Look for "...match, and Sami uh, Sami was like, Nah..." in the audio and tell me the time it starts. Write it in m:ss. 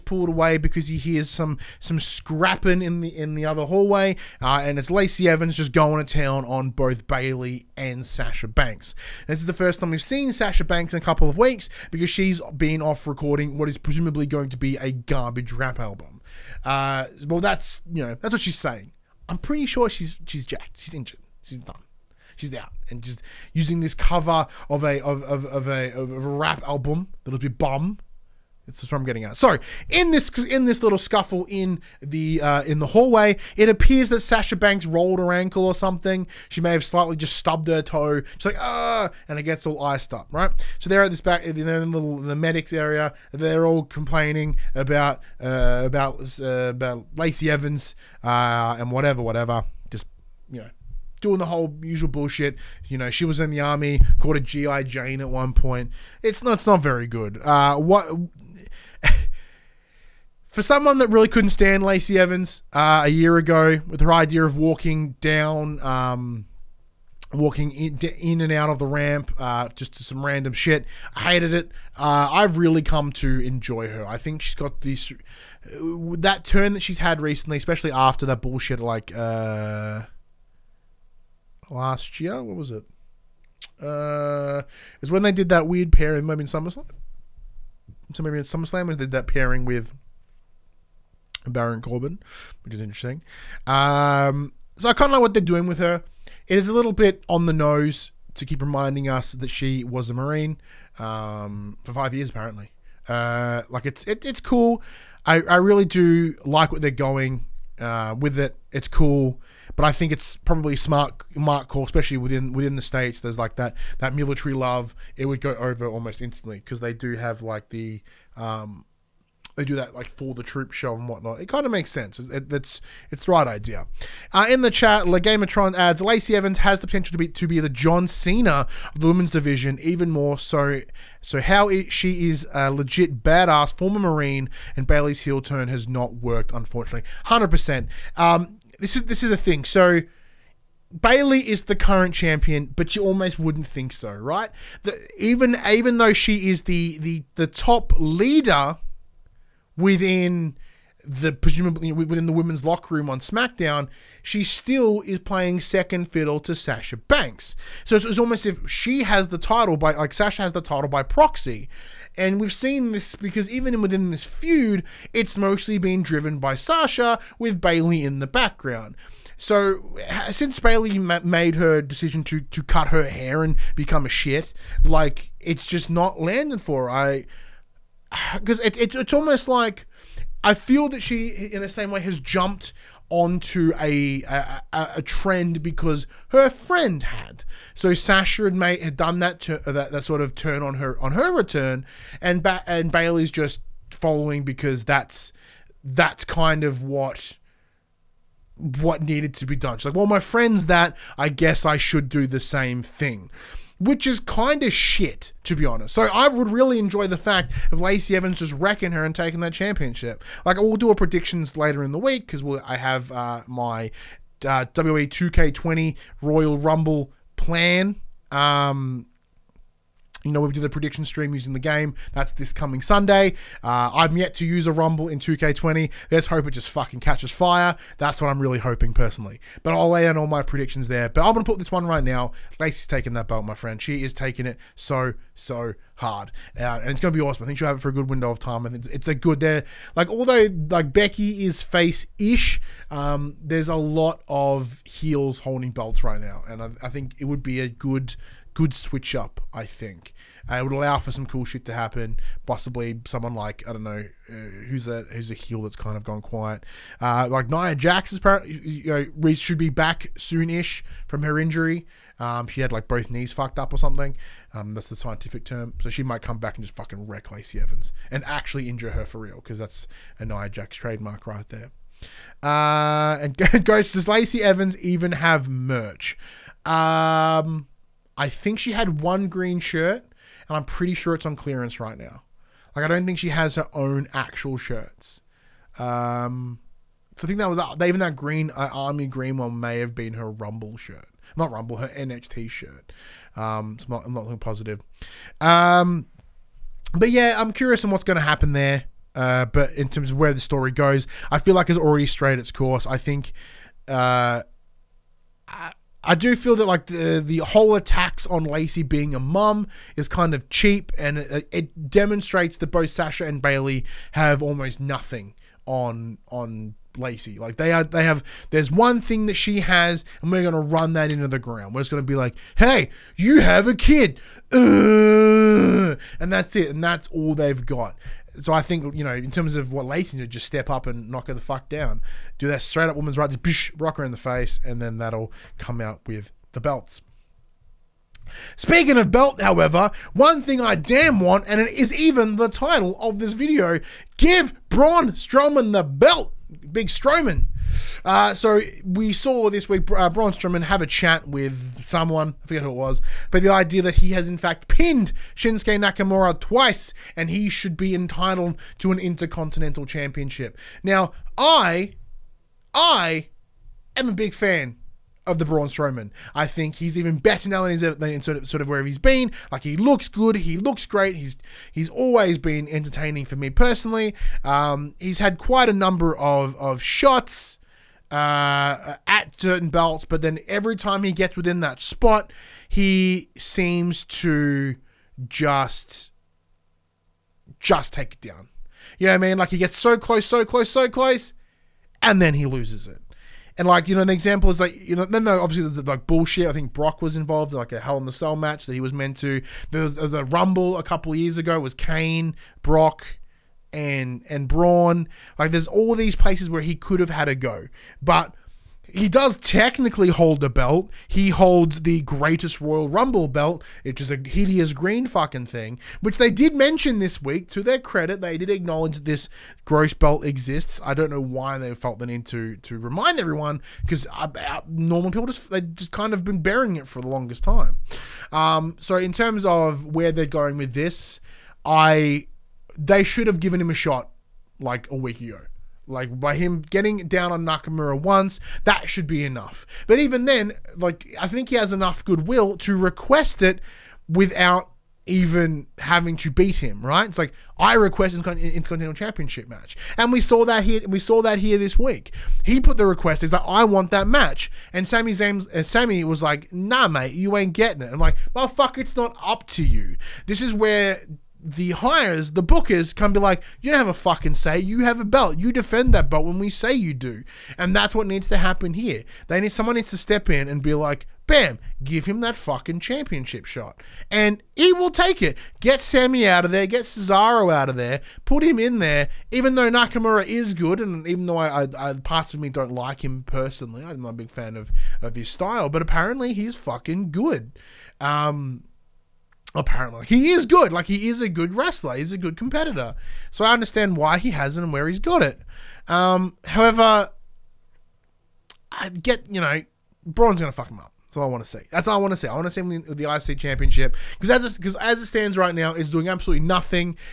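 7:34.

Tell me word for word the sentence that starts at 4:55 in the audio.
Um, but yeah, I'm curious on what's going to happen there.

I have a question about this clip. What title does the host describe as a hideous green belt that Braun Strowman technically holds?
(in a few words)
Greatest Royal Rumble belt.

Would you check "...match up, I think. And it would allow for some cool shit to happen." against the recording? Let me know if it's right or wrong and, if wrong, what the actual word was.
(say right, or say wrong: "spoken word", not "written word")
wrong: "switch", not "match".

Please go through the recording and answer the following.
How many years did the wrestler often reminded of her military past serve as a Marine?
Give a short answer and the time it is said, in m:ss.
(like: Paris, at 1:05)
5, at 1:41.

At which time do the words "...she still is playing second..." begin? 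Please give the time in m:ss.
2:34.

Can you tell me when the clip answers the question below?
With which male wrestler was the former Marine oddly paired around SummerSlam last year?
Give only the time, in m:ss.
1:31.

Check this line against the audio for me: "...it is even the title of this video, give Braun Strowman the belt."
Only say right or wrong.
right.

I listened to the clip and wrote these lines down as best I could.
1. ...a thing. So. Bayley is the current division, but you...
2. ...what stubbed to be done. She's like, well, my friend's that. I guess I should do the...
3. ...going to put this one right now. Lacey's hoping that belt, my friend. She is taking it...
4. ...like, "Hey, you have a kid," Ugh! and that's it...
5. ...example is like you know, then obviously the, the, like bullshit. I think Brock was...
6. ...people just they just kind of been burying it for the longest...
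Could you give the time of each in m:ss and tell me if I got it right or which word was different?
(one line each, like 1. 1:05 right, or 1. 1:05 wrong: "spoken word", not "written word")
1. 2:19 wrong: "champion", not "division"
2. 3:18 wrong: "needed", not "stubbed"
3. 3:51 wrong: "taking", not "hoping"
4. 5:22 right
5. 6:34 right
6. 7:05 right.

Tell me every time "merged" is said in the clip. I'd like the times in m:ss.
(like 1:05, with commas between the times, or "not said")
not said.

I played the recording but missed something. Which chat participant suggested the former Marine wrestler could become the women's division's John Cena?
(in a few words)
Legamatron.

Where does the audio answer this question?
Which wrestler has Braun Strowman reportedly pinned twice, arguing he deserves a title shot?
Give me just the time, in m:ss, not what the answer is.
5:55.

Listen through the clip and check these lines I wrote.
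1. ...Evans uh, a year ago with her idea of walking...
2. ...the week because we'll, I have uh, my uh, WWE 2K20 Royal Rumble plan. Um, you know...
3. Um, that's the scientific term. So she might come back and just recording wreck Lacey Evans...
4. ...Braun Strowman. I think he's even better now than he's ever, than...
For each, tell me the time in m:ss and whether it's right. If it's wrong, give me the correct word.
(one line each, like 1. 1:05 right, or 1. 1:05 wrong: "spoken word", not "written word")
1. 1:02 right
2. 3:31 right
3. 4:24 wrong: "fucking", not "recording"
4. 6:05 right.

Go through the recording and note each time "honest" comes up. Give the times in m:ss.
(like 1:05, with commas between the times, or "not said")
3:25.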